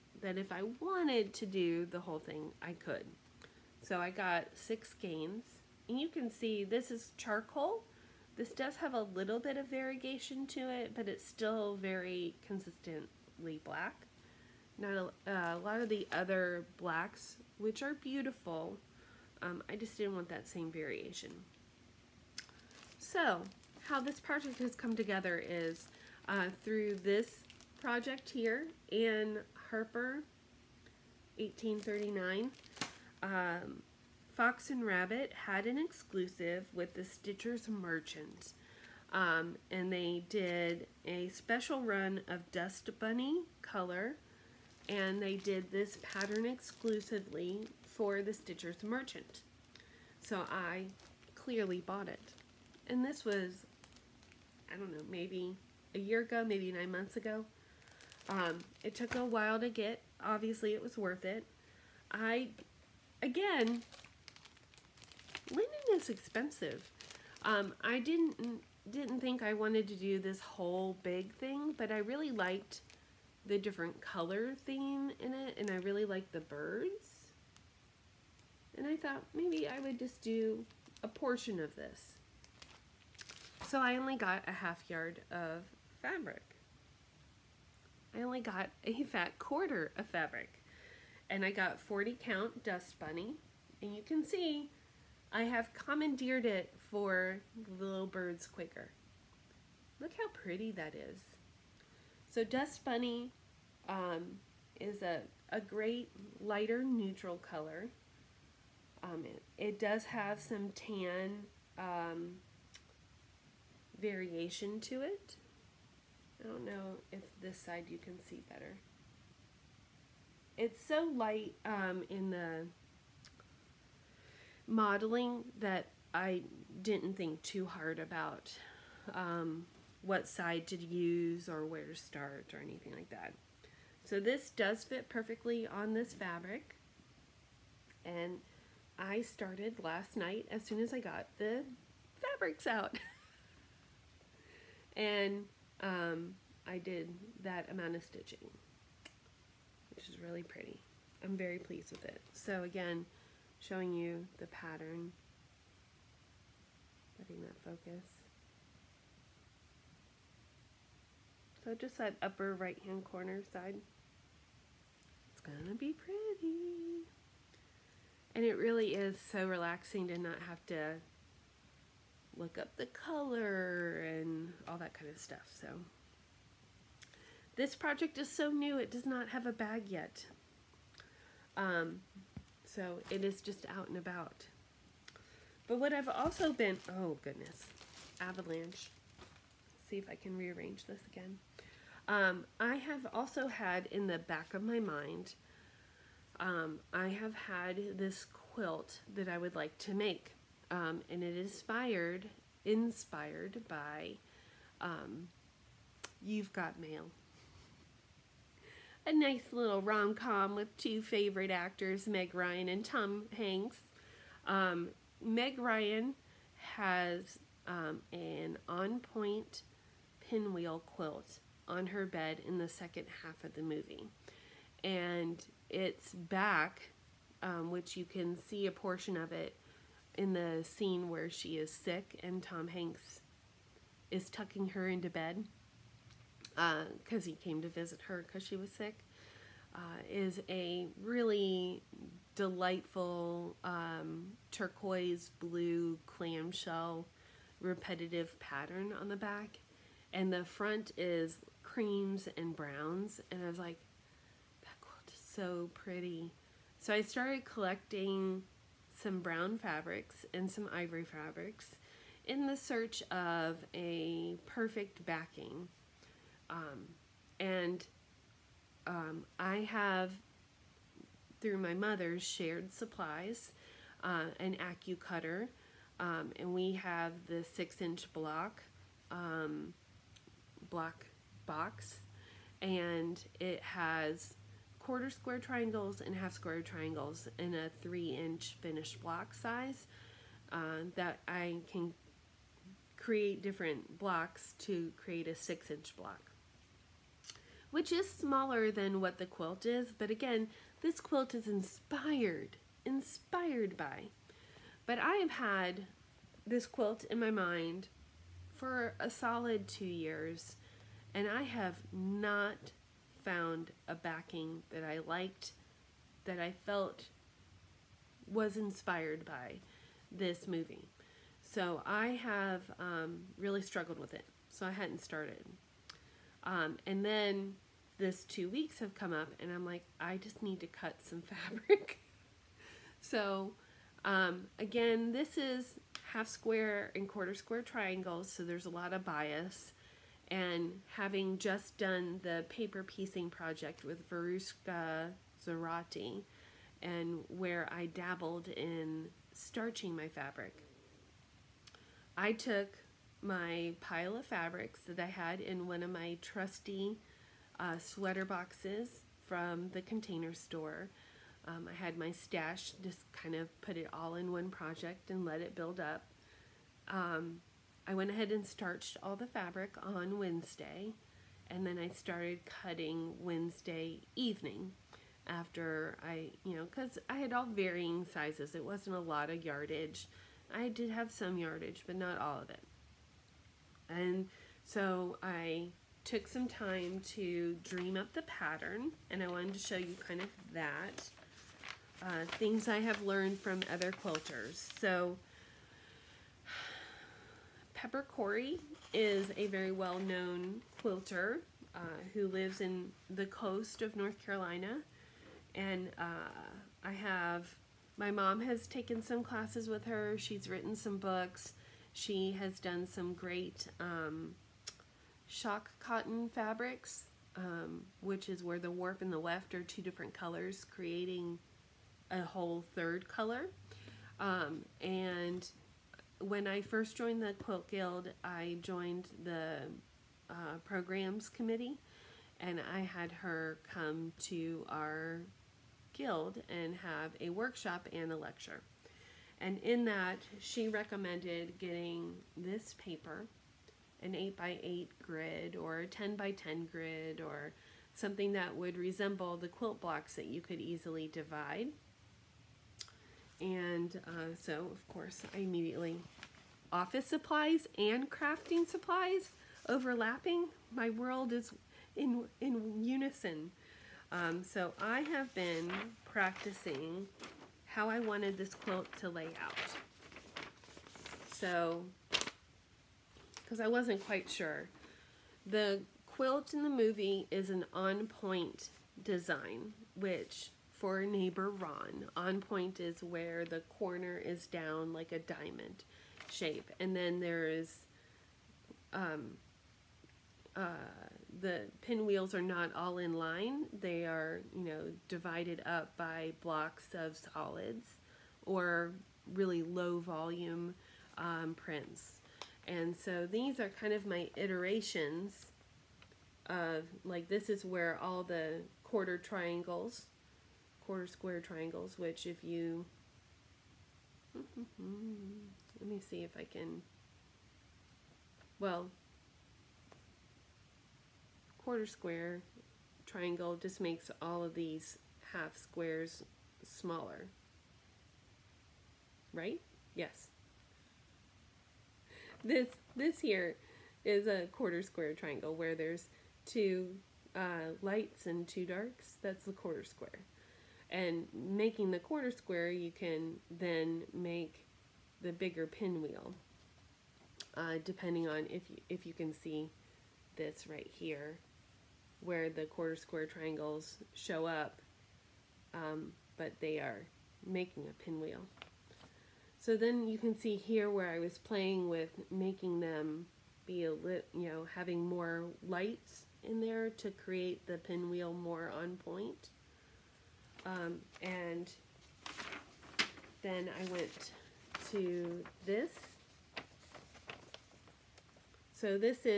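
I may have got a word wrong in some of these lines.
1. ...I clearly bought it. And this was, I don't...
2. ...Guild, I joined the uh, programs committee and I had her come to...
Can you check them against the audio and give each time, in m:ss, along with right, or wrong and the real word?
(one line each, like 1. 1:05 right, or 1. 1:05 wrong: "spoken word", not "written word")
1. 0:50 right
2. 7:07 right.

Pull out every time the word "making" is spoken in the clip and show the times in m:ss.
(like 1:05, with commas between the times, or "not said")
9:01, 9:17, 9:22.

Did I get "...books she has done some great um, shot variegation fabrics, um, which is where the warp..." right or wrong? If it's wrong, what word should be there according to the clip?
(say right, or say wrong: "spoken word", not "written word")
wrong: "cotton", not "variegation".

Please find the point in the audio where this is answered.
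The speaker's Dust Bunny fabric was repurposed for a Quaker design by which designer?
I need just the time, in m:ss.
1:37.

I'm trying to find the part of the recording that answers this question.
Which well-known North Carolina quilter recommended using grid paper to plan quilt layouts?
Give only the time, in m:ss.
6:37.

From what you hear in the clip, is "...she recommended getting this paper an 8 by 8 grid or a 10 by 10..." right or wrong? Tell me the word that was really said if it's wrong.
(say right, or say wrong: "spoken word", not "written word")
right.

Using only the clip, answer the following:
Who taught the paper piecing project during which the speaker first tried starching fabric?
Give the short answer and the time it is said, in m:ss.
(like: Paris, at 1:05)
Veruska Zerati, at 5:44.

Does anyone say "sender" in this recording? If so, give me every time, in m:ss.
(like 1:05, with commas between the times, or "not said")
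not said.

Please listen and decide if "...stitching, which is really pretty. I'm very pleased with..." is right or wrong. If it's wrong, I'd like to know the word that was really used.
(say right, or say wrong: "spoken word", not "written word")
right.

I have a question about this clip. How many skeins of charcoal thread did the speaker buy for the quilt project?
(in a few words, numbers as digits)
6.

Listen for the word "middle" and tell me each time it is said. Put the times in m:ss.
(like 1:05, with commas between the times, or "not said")
not said.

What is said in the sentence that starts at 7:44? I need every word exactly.
Um, so I have been practicing how I wanted this quilt to lay out.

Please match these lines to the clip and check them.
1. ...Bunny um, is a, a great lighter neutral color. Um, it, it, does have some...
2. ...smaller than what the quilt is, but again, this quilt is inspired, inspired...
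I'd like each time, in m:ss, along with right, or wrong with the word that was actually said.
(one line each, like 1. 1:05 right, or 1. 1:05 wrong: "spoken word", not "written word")
1. 1:42 right
2. 4:58 right.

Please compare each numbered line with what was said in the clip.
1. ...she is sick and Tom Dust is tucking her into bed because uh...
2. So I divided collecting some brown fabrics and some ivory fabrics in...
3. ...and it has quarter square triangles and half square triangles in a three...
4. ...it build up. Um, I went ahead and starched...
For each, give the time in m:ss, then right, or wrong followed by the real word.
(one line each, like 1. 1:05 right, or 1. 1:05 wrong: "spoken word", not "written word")
1. 3:51 wrong: "Hanks", not "Dust"
2. 4:16 wrong: "started", not "divided"
3. 4:42 right
4. 6:05 right.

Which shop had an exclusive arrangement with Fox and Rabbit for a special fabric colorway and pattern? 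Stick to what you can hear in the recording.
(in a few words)
Stitchers Merchants.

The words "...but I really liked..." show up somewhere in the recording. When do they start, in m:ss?
1:11.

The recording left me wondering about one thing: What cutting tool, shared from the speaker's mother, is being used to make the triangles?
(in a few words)
AccuCutter.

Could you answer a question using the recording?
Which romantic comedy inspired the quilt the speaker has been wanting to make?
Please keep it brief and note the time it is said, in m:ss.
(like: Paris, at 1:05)
You've Got Mail, at 3:26.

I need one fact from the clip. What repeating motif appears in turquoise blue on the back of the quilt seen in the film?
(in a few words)
clamshell.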